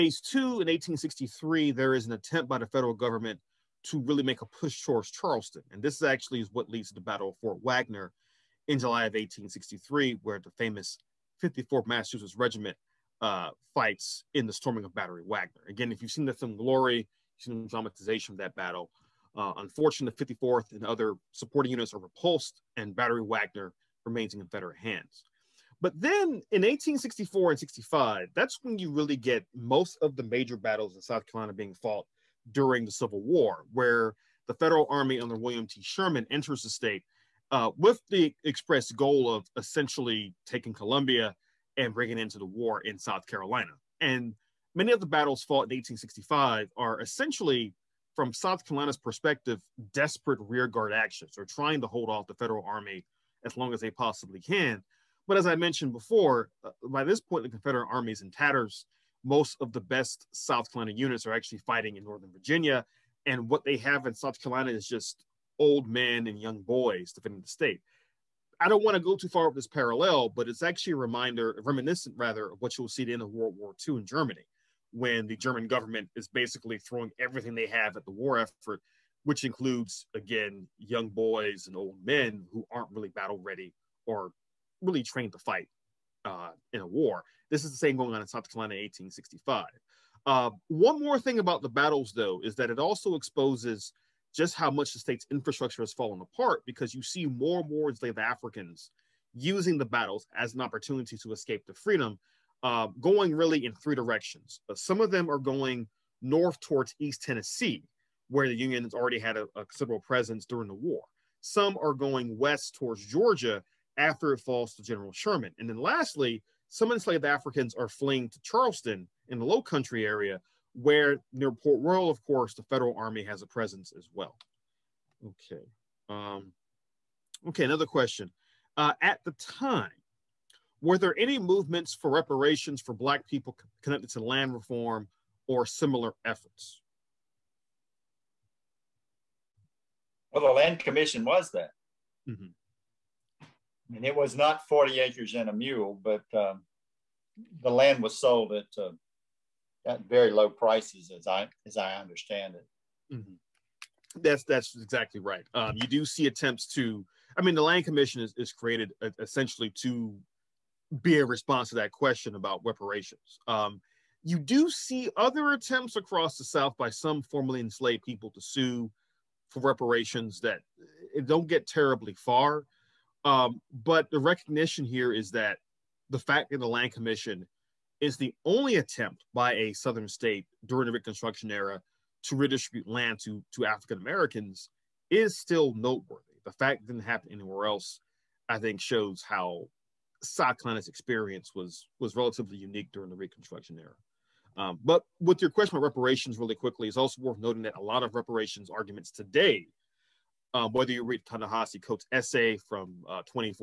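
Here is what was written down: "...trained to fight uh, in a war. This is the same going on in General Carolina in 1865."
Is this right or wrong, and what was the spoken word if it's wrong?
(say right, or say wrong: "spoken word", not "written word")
wrong: "South", not "General".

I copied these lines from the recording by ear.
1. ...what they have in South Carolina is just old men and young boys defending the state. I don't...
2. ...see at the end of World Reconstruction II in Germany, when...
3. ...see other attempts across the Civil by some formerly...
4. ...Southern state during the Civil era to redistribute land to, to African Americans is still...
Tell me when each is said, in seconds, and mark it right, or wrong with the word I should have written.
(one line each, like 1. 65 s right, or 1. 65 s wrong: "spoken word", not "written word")
1. 63 s right
2. 72 s wrong: "War", not "Reconstruction"
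3. 164 s wrong: "South", not "Civil"
4. 179 s wrong: "Reconstruction", not "Civil".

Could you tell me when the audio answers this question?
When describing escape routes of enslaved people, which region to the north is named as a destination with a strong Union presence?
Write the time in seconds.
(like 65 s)
106 s.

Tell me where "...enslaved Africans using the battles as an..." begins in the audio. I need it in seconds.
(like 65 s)
97 s.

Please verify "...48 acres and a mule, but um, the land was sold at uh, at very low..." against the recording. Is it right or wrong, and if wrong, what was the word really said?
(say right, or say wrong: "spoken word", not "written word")
wrong: "40", not "48".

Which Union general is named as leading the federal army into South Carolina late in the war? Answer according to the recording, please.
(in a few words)
William T. Sherman.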